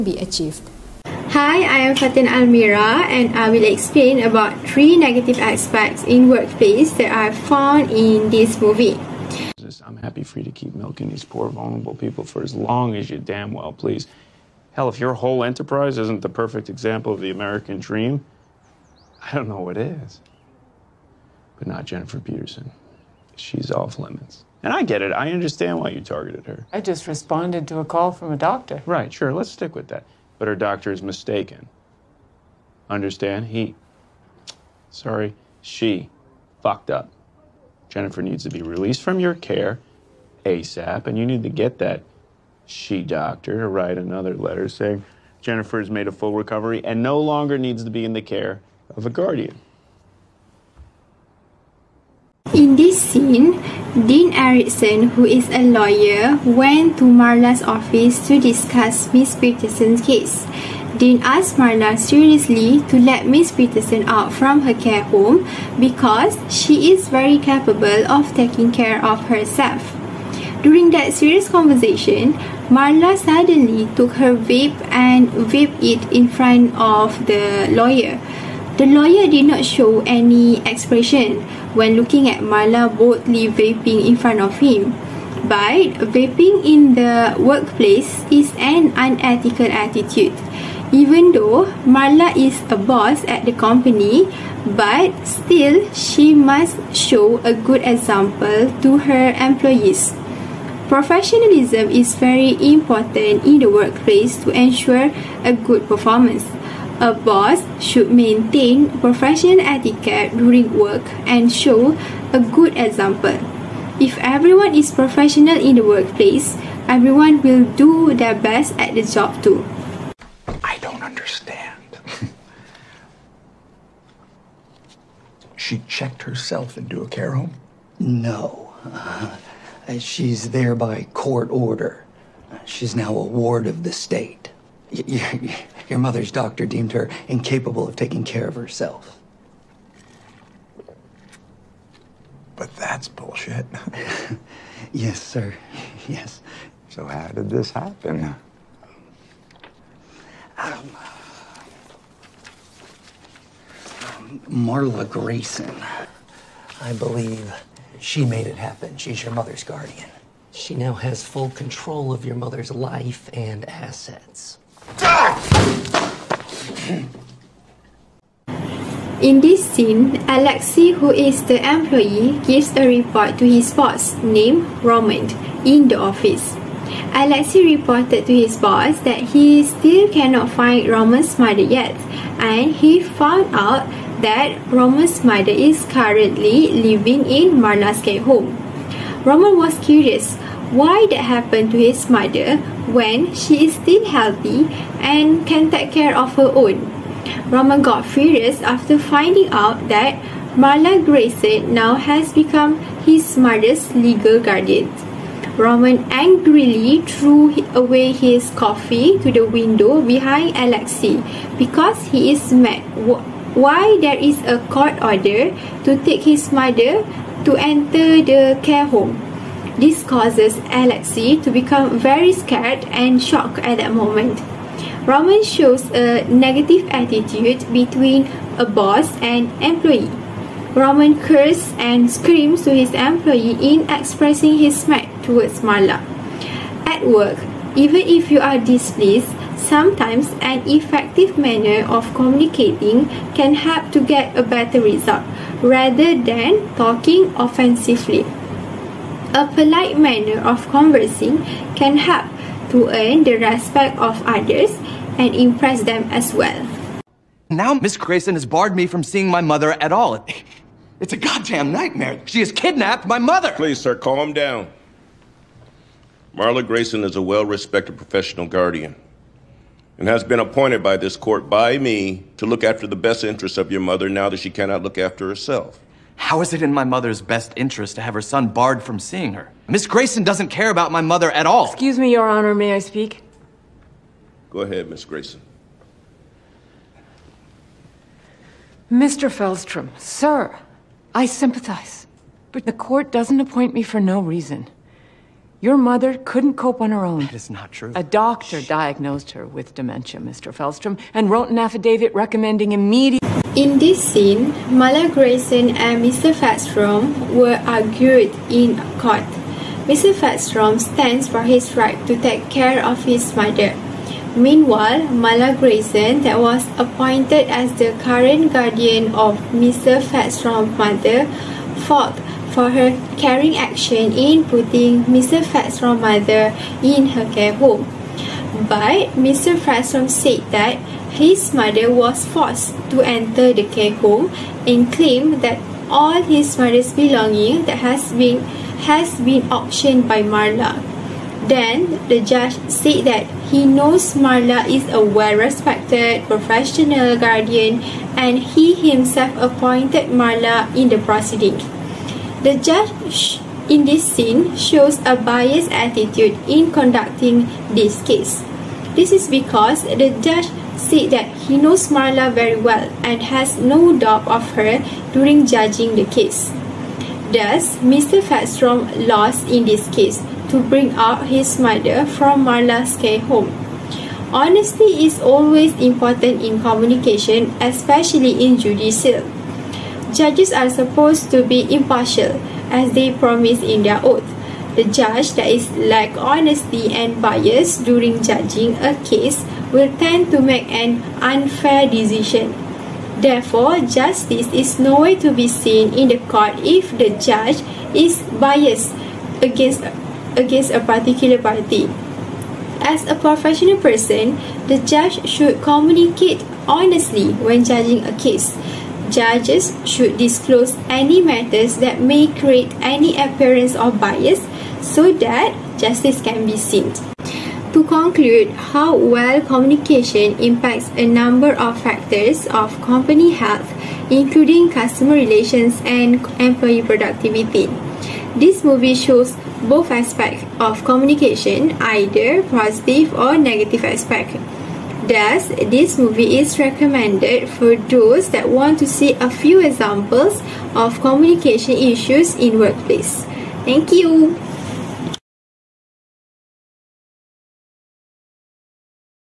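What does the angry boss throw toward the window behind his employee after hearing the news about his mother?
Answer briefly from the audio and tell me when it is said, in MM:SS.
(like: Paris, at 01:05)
coffee, at 03:28.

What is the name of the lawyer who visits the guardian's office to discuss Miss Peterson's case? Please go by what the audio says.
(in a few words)
Dean Erickson.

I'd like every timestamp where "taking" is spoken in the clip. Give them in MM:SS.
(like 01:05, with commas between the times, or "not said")
01:08, 02:17.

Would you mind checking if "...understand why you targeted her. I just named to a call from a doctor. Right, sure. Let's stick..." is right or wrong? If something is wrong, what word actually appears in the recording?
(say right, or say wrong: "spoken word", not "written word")
wrong: "responded", not "named".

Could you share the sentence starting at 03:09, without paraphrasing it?
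Roman was curious why that happened to his mother when she is still healthy and can take care of her own.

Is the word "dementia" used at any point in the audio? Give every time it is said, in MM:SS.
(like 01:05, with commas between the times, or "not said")
04:59.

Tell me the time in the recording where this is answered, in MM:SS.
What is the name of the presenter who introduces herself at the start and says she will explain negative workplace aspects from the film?
00:01.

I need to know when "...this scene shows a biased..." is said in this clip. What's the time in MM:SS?
05:53.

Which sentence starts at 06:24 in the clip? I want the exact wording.
The judge that is lack honesty and bias during judging a case will tend to make an unfair decision.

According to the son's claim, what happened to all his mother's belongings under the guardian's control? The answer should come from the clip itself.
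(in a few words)
auctioned.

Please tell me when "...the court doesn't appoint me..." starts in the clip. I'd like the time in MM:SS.
04:52.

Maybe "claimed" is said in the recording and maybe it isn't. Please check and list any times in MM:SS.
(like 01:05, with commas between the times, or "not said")
05:34.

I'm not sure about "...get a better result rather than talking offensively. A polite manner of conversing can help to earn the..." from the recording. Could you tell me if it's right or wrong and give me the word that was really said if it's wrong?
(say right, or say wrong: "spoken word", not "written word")
right.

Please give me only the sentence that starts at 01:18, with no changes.
The lawyer did not show any expression when looking at Marla boldly vaping in front of him.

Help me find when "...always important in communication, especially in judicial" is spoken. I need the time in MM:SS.
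06:15.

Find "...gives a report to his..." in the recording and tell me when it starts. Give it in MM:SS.
02:52.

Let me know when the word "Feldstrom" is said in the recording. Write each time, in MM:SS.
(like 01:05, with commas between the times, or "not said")
04:49, 05:00.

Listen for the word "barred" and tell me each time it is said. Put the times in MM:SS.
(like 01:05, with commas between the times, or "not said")
04:18, 04:38.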